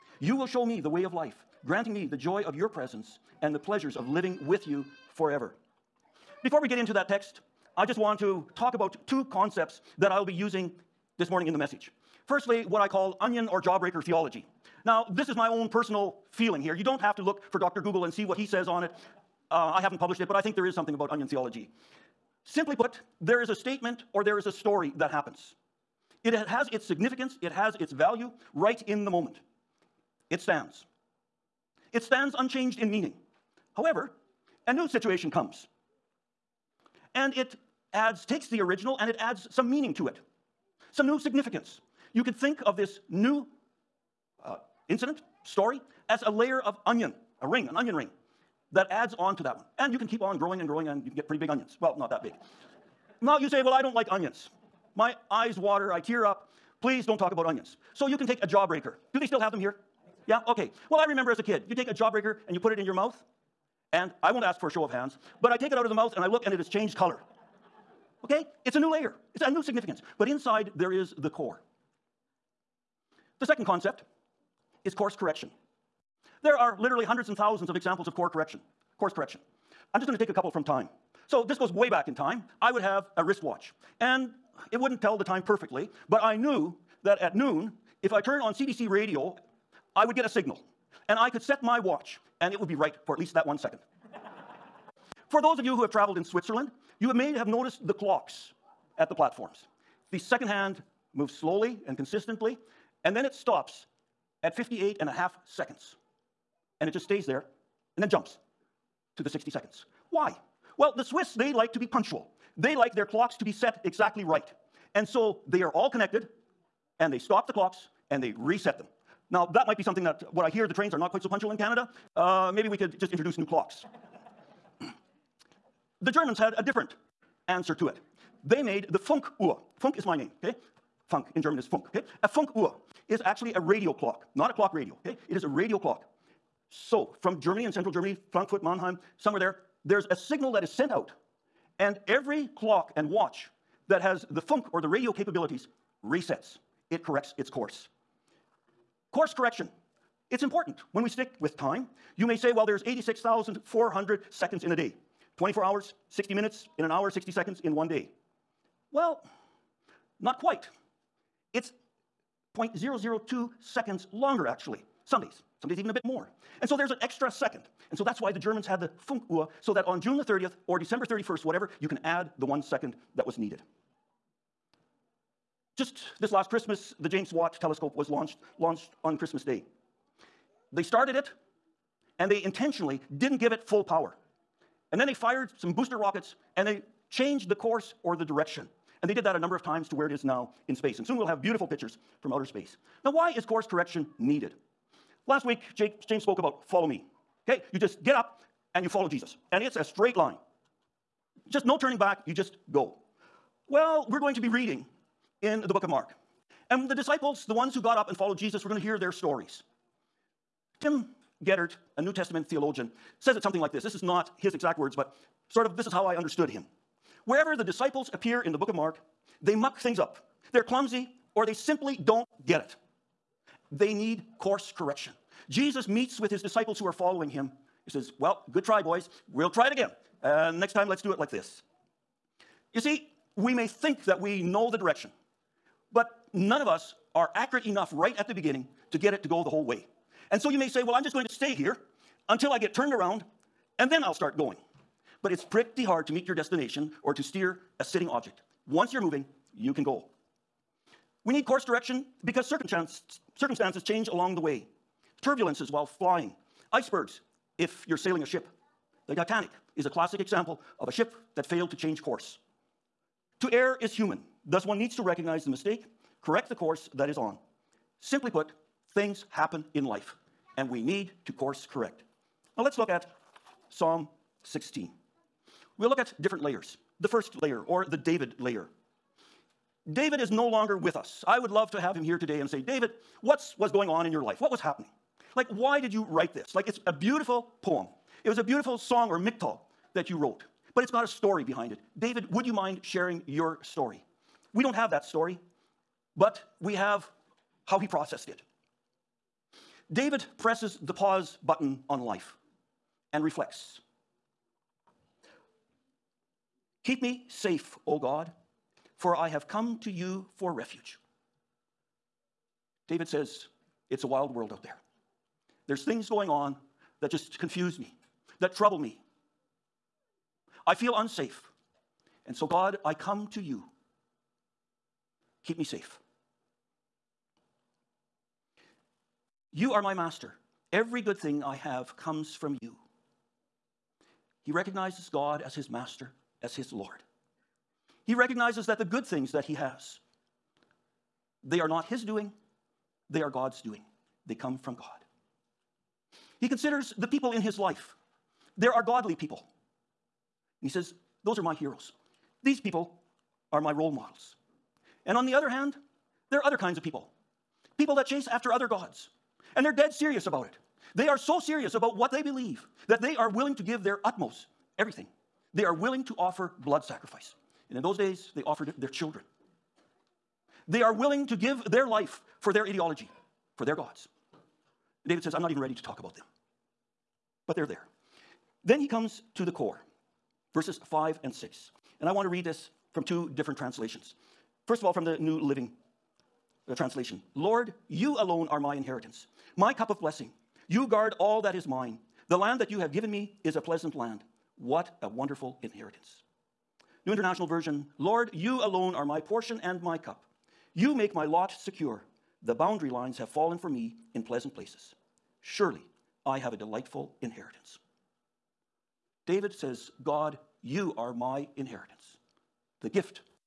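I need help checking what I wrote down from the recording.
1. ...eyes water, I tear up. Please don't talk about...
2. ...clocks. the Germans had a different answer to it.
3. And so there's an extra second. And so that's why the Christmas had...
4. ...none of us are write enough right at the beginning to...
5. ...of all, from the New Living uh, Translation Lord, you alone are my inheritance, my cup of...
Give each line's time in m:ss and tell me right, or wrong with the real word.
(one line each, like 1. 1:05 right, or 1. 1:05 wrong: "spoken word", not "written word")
1. 0:55 right
2. 2:03 right
3. 2:46 wrong: "Germans", not "Christmas"
4. 3:56 wrong: "accurate", not "write"
5. 6:24 right.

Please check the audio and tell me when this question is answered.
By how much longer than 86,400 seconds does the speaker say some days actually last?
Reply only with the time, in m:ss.
2:42.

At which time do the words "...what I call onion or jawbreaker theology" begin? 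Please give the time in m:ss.
0:12.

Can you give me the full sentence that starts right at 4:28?
Simply put, things happen in life, and we need to course correct.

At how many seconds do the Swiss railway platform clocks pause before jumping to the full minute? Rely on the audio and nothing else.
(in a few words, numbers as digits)
58 and a half seconds.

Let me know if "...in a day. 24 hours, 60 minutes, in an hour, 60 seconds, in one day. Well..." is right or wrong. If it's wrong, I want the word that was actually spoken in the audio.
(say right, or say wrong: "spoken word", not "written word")
right.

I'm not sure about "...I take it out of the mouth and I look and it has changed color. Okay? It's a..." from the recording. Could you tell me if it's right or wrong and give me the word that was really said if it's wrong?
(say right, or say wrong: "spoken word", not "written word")
right.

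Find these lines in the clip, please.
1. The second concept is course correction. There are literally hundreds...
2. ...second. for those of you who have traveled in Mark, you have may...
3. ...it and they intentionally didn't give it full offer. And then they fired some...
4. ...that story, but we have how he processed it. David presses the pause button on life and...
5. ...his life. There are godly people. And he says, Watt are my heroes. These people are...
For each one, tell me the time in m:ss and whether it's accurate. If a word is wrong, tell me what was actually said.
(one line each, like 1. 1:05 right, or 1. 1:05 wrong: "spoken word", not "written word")
1. 1:13 right
2. 1:33 wrong: "Switzerland", not "Mark"
3. 3:01 wrong: "power", not "offer"
4. 4:54 right
5. 5:47 wrong: "Those", not "Watt".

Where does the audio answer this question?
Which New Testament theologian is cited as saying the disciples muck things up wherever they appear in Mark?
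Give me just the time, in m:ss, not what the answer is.
3:30.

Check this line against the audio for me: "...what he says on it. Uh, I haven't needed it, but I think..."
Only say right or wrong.
wrong.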